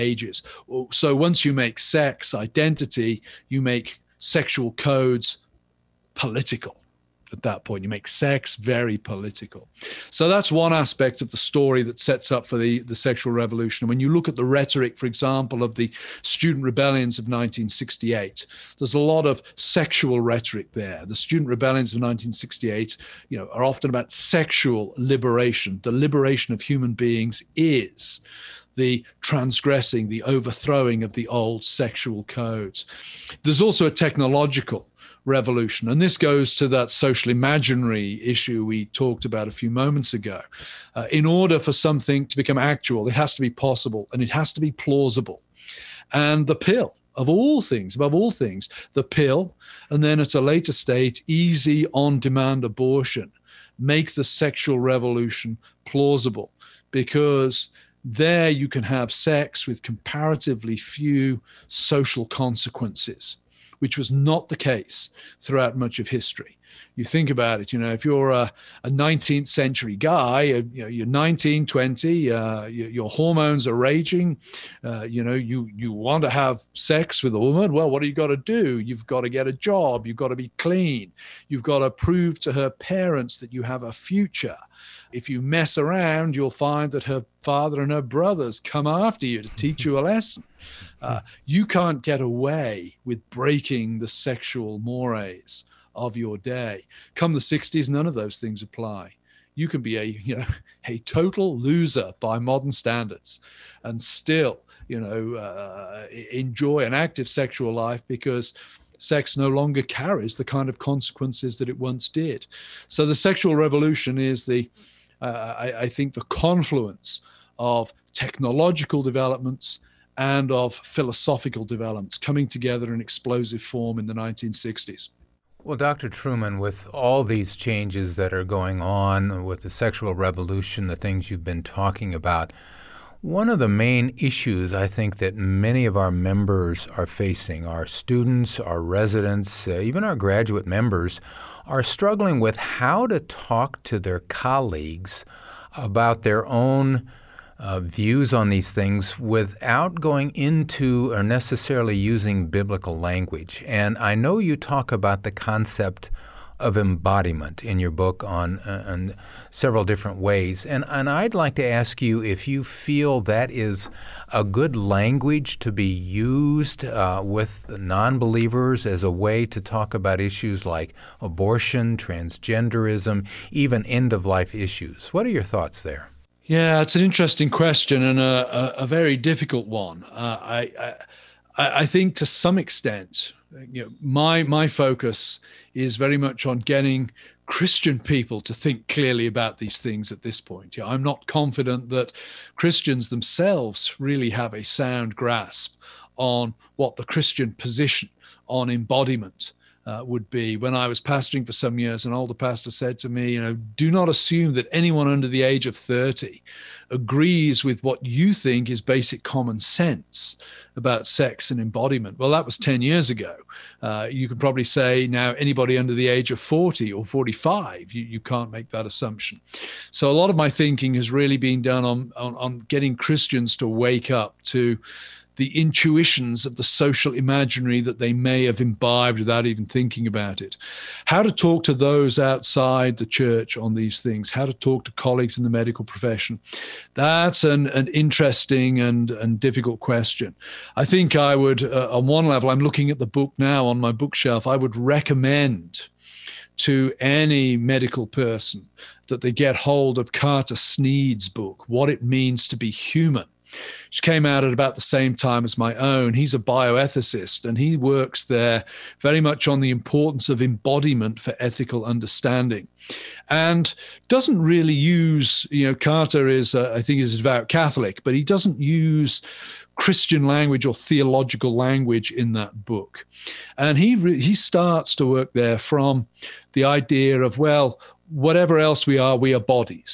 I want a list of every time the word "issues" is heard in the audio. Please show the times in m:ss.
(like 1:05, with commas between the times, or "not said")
0:38, 2:14, 2:50, 2:54.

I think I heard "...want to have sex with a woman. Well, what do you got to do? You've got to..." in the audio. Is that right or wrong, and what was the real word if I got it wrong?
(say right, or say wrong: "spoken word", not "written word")
right.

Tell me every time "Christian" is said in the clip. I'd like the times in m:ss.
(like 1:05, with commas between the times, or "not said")
3:07, 3:12, 3:17, 3:42, 4:29.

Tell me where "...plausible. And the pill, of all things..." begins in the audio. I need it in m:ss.
0:44.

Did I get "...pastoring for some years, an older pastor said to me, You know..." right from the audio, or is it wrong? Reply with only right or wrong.
right.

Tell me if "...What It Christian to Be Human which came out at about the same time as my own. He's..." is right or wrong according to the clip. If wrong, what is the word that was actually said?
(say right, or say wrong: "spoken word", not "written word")
wrong: "Means", not "Christian".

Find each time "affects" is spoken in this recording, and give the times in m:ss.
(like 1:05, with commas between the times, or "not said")
not said.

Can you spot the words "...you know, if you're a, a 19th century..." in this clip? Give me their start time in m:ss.
1:07.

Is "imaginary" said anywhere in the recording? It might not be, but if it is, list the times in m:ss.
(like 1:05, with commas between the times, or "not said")
0:37, 3:47.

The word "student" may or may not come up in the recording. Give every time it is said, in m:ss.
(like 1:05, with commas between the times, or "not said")
0:16, 0:21, 2:17.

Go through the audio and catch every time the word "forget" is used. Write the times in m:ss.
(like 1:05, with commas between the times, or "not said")
not said.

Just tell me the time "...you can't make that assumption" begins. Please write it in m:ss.
3:38.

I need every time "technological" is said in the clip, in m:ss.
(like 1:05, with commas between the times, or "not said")
0:33, 1:58.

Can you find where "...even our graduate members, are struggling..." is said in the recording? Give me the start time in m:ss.
2:19.